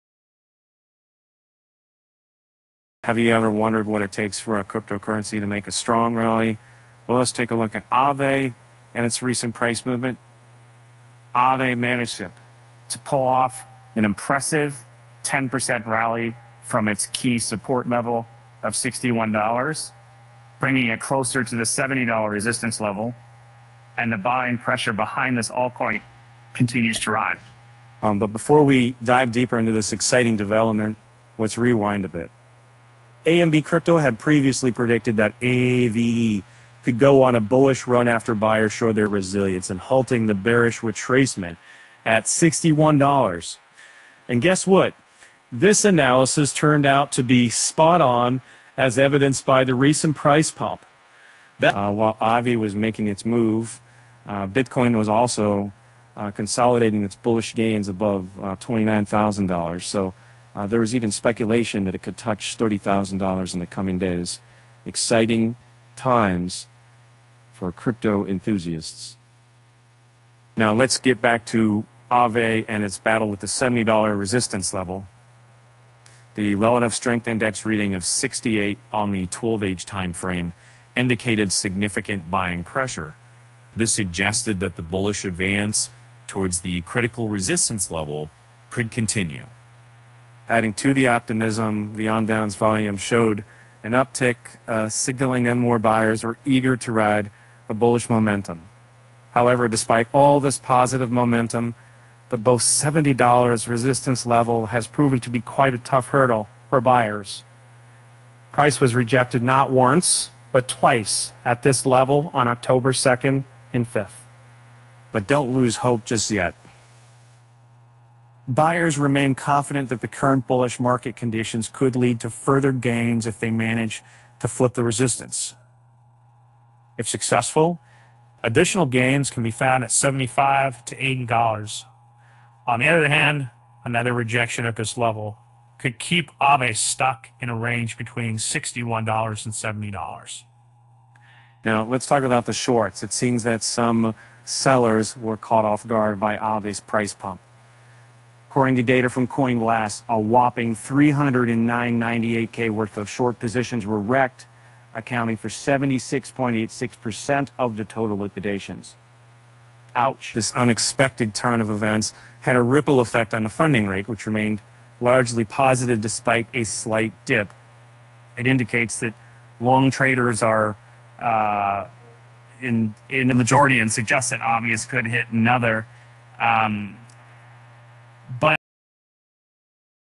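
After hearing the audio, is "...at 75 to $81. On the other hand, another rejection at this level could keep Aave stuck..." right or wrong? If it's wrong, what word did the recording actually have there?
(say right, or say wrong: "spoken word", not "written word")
wrong: "80", not "81".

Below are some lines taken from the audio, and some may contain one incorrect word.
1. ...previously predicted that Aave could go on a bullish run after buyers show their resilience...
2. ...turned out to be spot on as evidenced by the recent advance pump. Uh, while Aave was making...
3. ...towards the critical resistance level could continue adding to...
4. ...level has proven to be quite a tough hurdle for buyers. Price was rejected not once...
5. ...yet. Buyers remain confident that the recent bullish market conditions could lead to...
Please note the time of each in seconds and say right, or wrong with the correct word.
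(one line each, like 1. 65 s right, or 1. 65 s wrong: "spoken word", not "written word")
1. 34 s right
2. 46 s wrong: "price", not "advance"
3. 86 s right
4. 104 s right
5. 116 s wrong: "current", not "recent".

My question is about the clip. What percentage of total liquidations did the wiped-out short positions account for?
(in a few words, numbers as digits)
76.86%.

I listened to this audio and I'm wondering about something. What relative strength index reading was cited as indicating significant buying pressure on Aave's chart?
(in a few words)
68.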